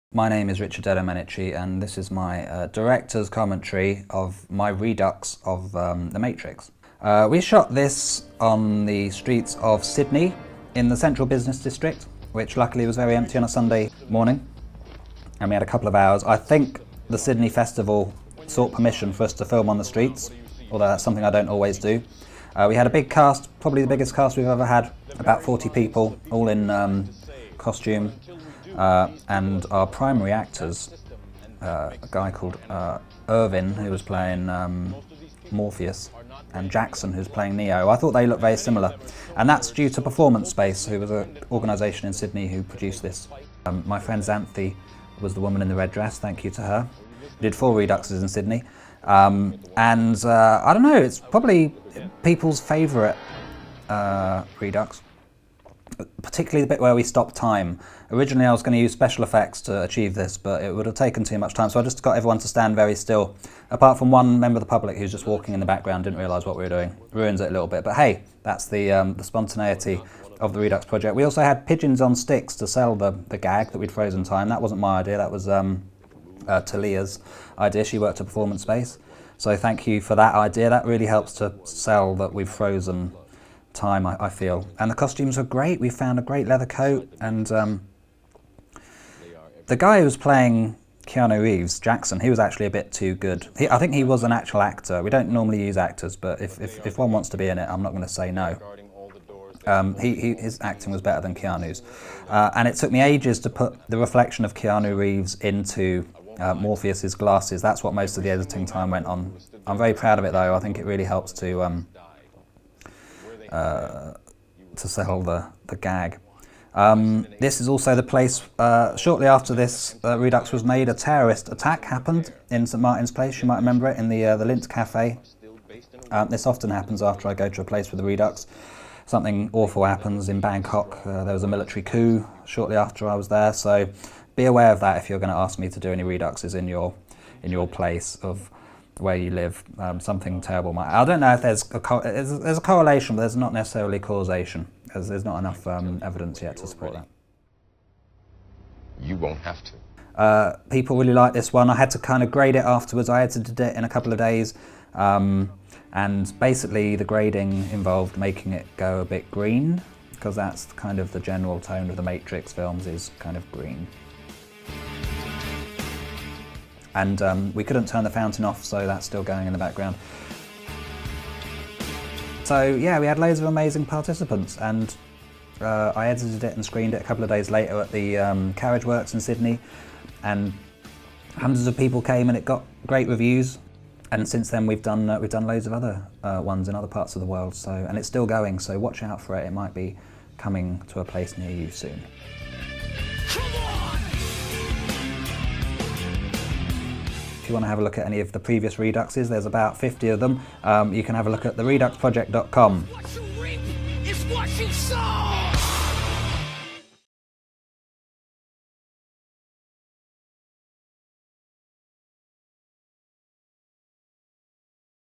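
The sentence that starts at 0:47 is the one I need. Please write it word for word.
We did four reduxes in Sydney.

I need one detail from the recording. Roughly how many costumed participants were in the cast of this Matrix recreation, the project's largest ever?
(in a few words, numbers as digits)
40.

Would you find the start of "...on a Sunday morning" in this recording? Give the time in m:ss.
0:13.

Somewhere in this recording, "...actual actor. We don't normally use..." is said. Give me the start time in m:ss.
1:34.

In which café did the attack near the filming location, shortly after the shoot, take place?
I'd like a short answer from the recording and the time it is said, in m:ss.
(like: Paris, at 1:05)
Lindt Cafe, at 2:04.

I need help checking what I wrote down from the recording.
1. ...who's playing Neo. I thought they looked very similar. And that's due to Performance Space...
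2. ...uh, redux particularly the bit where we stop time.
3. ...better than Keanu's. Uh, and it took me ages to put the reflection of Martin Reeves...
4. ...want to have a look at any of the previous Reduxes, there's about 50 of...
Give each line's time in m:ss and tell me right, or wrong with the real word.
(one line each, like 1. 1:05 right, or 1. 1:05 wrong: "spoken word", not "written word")
1. 0:37 right
2. 0:53 right
3. 1:41 wrong: "Keanu", not "Martin"
4. 3:17 right.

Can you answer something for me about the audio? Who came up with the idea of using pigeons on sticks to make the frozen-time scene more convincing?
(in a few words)
Talia.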